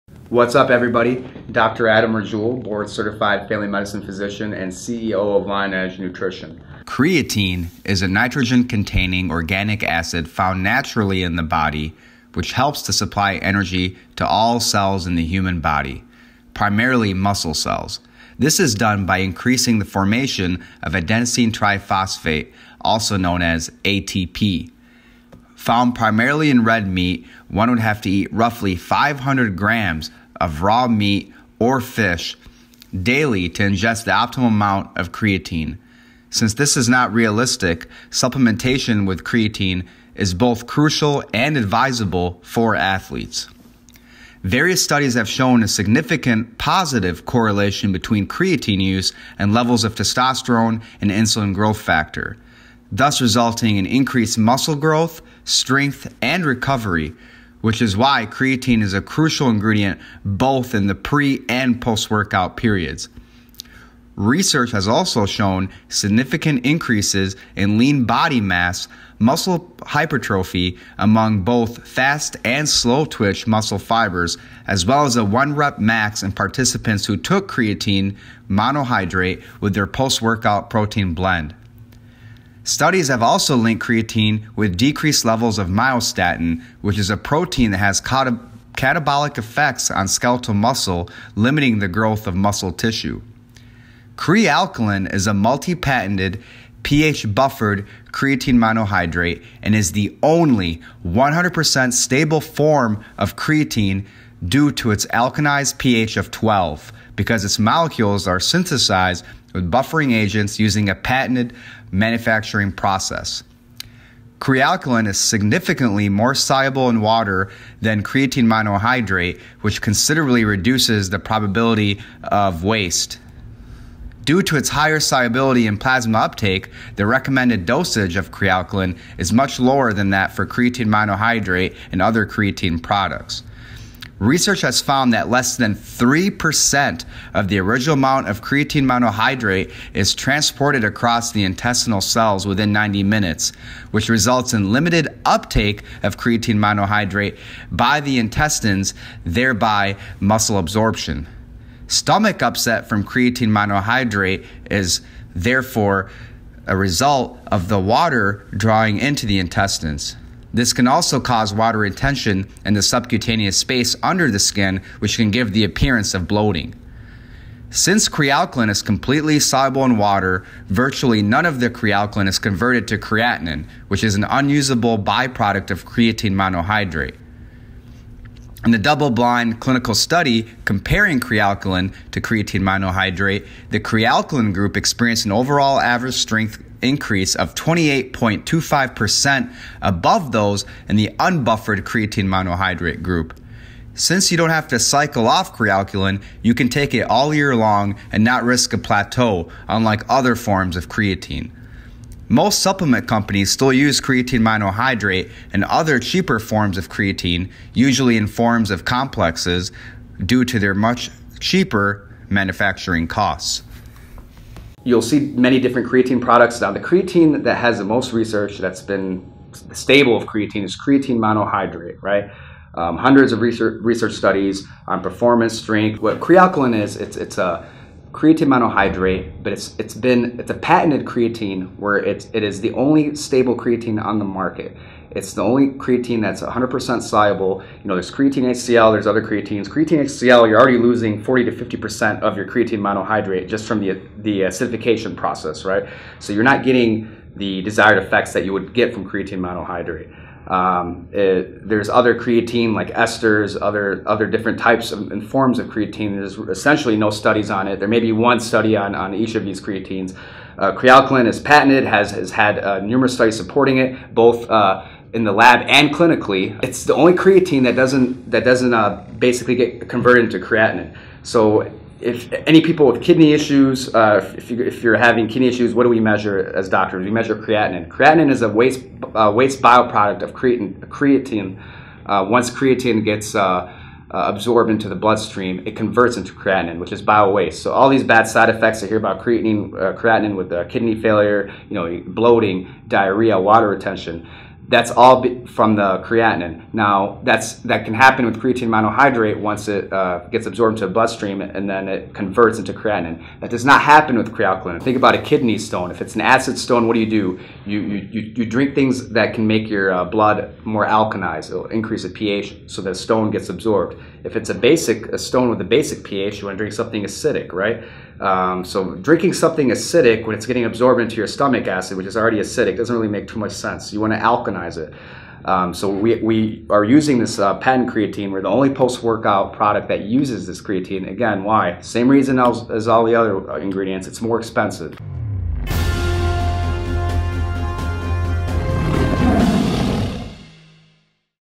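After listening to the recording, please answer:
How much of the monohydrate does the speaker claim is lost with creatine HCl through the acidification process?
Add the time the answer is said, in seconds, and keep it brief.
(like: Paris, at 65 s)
40 to 50%, at 241 s.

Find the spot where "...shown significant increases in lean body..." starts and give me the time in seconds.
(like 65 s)
65 s.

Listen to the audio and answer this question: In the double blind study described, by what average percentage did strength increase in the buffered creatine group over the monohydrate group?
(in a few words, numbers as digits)
28.25%.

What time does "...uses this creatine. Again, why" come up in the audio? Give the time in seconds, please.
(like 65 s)
330 s.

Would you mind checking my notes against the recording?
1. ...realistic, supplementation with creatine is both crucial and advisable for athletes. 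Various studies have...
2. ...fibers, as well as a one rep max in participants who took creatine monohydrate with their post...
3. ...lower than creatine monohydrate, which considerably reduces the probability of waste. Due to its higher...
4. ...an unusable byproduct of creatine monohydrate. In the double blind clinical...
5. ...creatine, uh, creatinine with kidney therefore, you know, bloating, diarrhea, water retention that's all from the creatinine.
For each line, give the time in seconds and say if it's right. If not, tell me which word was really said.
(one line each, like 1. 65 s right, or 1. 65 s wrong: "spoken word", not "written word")
1. 37 s right
2. 73 s right
3. 117 s wrong: "water", not "lower"
4. 174 s right
5. 289 s wrong: "failure", not "therefore".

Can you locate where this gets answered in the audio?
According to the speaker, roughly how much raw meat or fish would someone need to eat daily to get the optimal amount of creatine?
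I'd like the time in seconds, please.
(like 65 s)
28 s.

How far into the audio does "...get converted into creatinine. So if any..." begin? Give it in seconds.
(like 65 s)
269 s.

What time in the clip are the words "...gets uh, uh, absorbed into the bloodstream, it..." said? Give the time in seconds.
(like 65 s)
283 s.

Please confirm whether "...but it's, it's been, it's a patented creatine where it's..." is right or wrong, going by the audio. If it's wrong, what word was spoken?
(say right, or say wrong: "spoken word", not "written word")
right.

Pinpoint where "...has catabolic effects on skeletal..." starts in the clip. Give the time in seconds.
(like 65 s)
87 s.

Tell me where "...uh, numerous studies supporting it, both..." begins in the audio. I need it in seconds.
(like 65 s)
262 s.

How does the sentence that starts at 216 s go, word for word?
Now, the creatine that has the most research that's been stable of creatine is creatine monohydrate, right?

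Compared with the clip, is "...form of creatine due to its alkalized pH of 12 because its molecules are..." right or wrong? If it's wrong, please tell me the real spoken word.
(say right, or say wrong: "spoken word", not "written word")
right.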